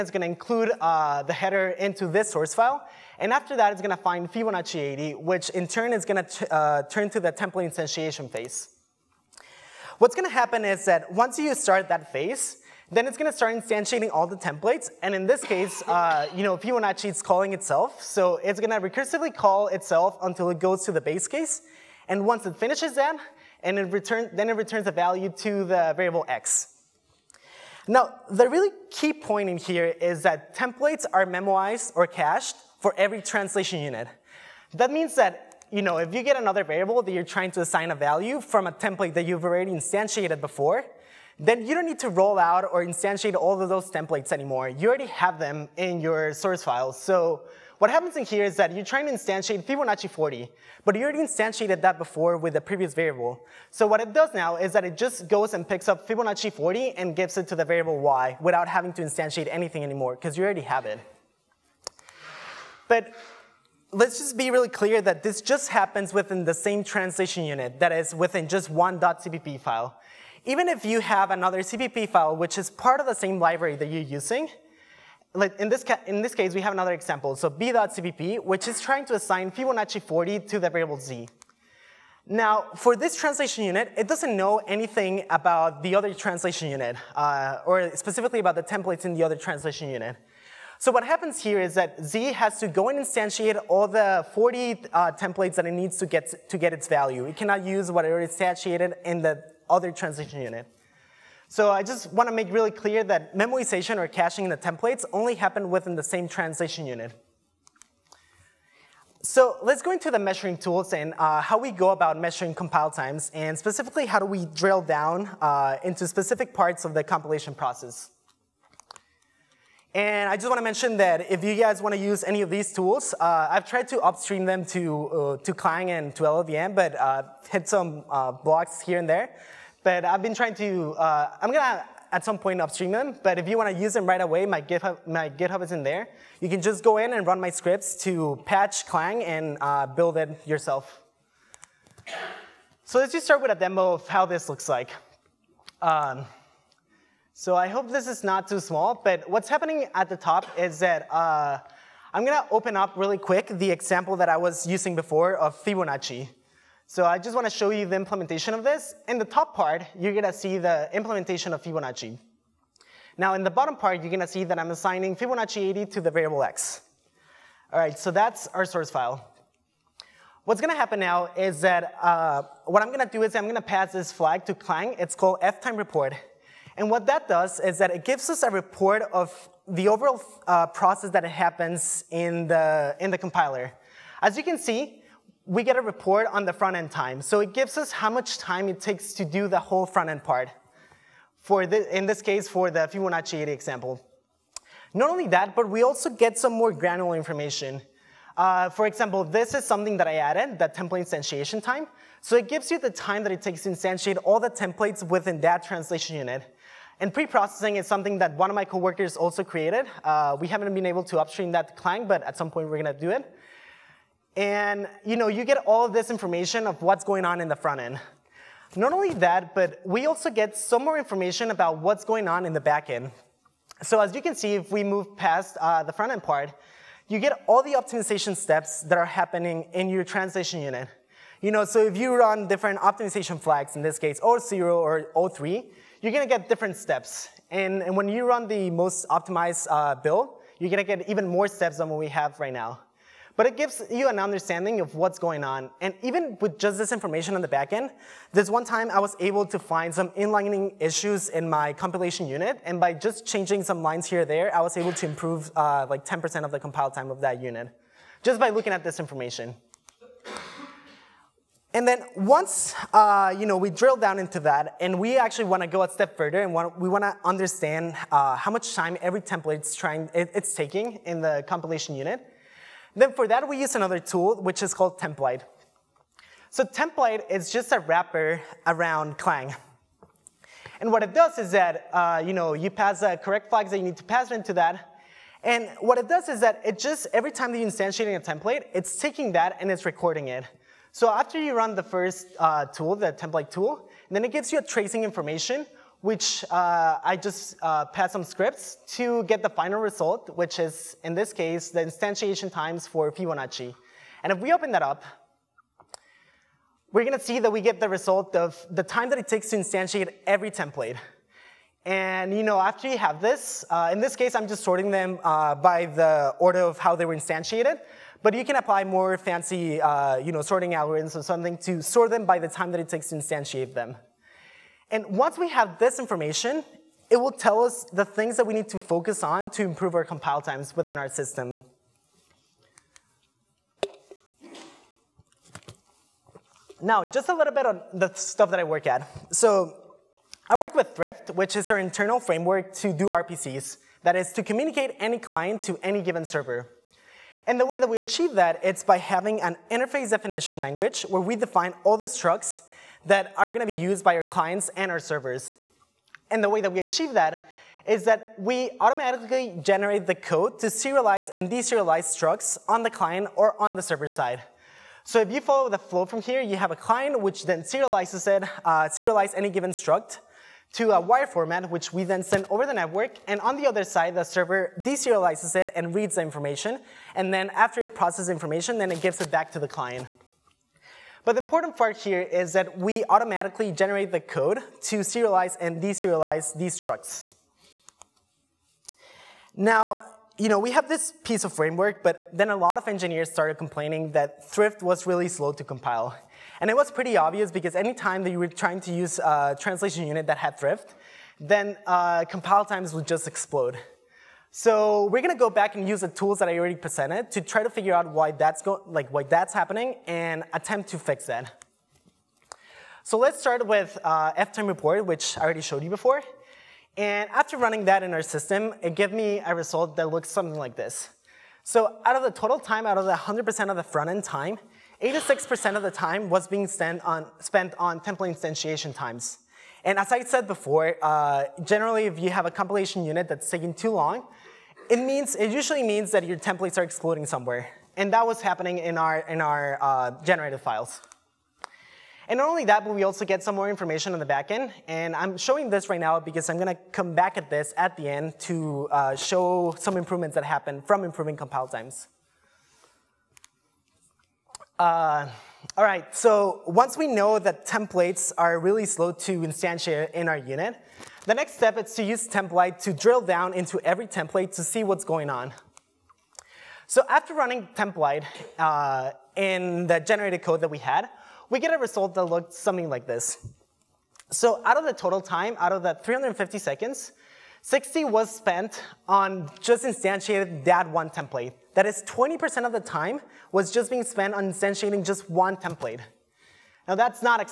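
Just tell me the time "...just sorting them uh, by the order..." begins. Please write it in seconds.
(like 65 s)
314 s.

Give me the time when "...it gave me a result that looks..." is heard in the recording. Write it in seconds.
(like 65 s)
418 s.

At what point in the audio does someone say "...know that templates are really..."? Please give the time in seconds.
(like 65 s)
457 s.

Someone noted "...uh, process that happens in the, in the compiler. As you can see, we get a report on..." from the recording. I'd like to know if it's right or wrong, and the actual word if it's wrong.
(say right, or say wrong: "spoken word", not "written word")
right.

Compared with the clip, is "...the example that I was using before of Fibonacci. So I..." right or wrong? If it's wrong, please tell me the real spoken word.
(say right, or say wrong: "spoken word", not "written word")
right.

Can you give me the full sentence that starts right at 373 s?
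And on the other side, the server deserializes it and reads the information.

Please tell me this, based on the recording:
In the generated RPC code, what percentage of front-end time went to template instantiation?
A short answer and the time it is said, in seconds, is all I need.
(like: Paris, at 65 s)
86%, at 425 s.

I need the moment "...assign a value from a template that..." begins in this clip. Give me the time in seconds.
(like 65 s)
37 s.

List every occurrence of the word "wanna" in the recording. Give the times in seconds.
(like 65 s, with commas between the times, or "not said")
157 s, 266 s.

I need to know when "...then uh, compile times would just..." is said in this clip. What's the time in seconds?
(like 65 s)
401 s.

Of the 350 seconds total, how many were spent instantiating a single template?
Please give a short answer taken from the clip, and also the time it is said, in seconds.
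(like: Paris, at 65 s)
60, at 477 s.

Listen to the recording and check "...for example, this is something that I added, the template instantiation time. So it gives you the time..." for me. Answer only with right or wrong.
right.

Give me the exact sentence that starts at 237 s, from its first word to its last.
And, and when you run the most optimized uh, build, you're gonna get even more steps than what we have right now.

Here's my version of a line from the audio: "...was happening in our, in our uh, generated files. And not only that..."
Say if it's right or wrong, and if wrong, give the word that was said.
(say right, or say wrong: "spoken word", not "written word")
right.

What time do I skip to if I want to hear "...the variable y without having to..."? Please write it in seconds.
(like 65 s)
57 s.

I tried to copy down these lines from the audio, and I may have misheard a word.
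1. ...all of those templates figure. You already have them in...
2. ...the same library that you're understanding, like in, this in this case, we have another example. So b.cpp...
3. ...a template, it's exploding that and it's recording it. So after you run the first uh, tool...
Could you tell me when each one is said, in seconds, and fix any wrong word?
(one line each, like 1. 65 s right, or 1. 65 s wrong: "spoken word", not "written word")
1. 43 s wrong: "anymore", not "figure"
2. 73 s wrong: "using", not "understanding"
3. 288 s wrong: "taking", not "exploding".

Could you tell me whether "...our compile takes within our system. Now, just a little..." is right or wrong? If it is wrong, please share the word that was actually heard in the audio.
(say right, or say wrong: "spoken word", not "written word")
wrong: "times", not "takes".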